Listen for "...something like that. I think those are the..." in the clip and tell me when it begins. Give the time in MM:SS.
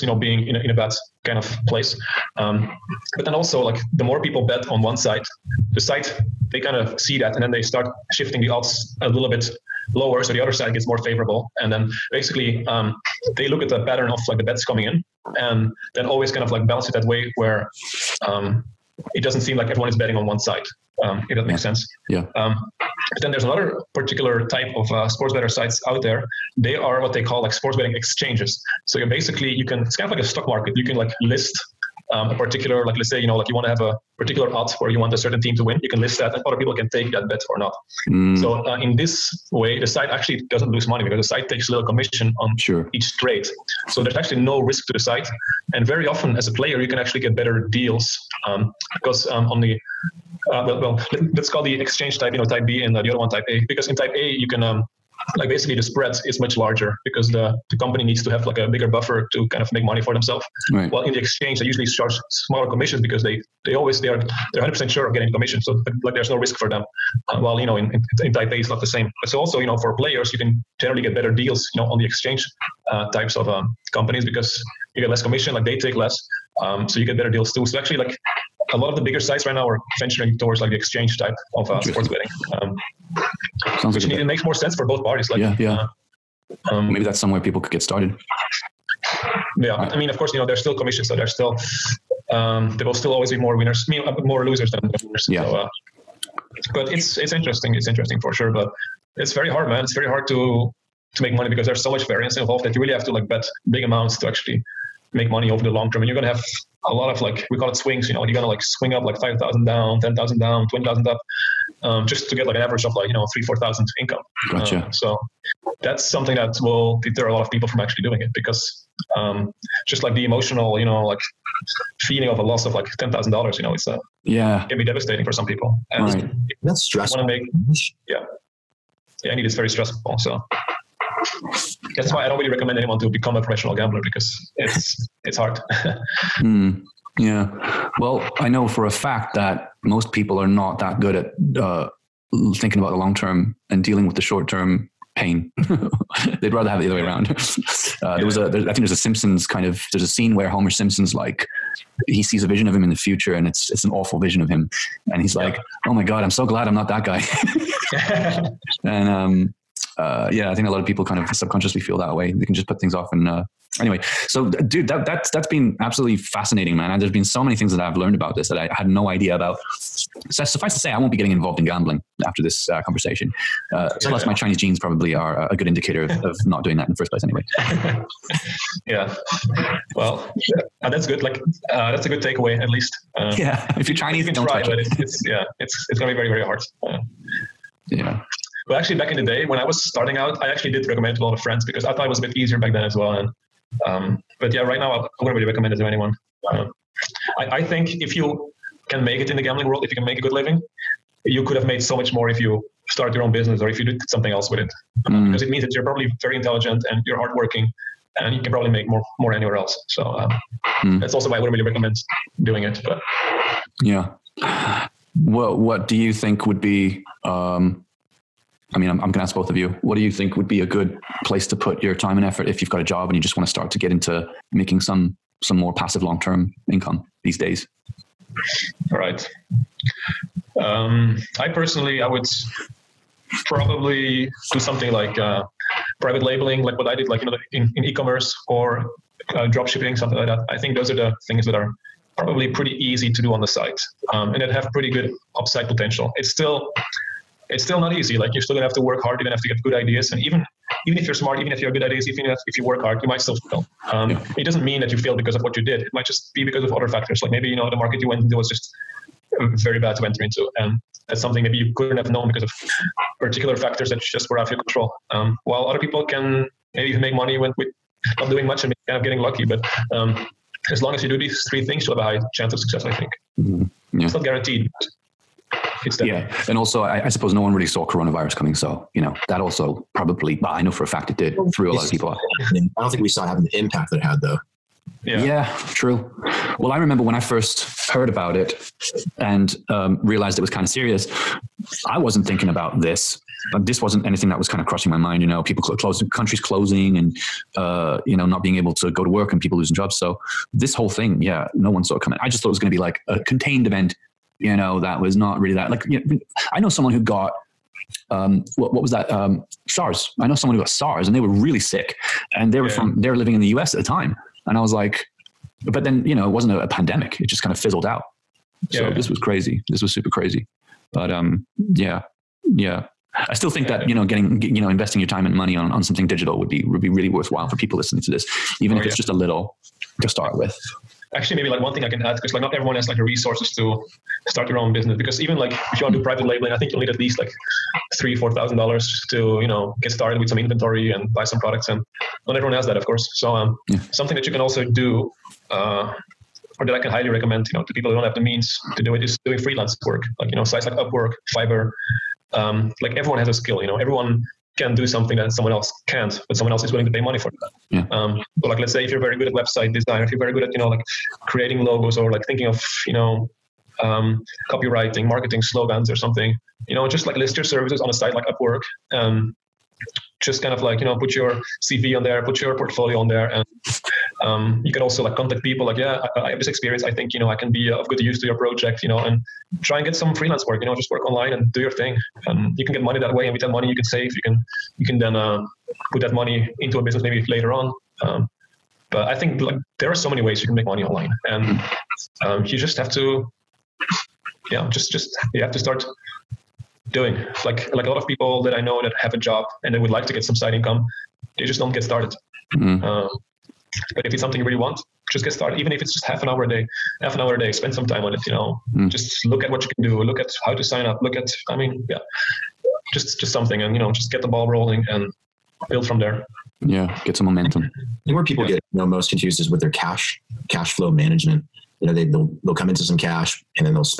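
04:00.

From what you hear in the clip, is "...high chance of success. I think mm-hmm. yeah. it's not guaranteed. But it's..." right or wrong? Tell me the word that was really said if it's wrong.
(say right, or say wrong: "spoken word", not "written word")
right.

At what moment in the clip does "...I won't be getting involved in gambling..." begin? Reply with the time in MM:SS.
02:50.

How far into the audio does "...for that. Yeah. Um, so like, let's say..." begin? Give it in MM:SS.
05:57.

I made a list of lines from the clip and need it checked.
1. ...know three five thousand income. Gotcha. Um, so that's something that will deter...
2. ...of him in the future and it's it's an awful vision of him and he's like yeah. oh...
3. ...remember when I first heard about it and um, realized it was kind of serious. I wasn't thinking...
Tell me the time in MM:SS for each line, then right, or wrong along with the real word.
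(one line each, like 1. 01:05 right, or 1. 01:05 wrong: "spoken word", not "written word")
1. 01:53 wrong: "four", not "five"
2. 02:32 right
3. 04:46 right.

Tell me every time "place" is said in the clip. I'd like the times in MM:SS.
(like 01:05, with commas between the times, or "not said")
00:01, 02:57, 03:41.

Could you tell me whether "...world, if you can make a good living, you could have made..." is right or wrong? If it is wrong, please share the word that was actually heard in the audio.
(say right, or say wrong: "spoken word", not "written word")
right.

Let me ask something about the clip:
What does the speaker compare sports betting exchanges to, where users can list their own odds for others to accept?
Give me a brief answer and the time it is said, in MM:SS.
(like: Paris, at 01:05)
A stock market, at 00:30.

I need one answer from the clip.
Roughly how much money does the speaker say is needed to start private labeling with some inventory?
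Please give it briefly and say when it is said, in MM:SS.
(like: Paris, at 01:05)
$3,000-4,000, at 05:37.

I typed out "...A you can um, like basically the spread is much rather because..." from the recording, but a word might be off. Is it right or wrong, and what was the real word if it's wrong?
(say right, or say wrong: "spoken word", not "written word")
wrong: "larger", not "rather".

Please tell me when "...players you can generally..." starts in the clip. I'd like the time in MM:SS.
01:09.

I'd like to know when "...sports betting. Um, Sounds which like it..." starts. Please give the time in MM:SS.
01:21.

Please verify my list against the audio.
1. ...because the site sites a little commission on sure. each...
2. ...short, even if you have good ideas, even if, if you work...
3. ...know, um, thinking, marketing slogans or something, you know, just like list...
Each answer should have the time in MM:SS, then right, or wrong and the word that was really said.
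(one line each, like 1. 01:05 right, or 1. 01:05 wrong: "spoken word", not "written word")
1. 00:41 wrong: "takes", not "sites"
2. 04:11 wrong: "smart", not "short"
3. 06:02 wrong: "copywriting", not "thinking".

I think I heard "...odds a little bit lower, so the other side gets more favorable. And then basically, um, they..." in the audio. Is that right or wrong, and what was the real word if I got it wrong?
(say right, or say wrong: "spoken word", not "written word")
right.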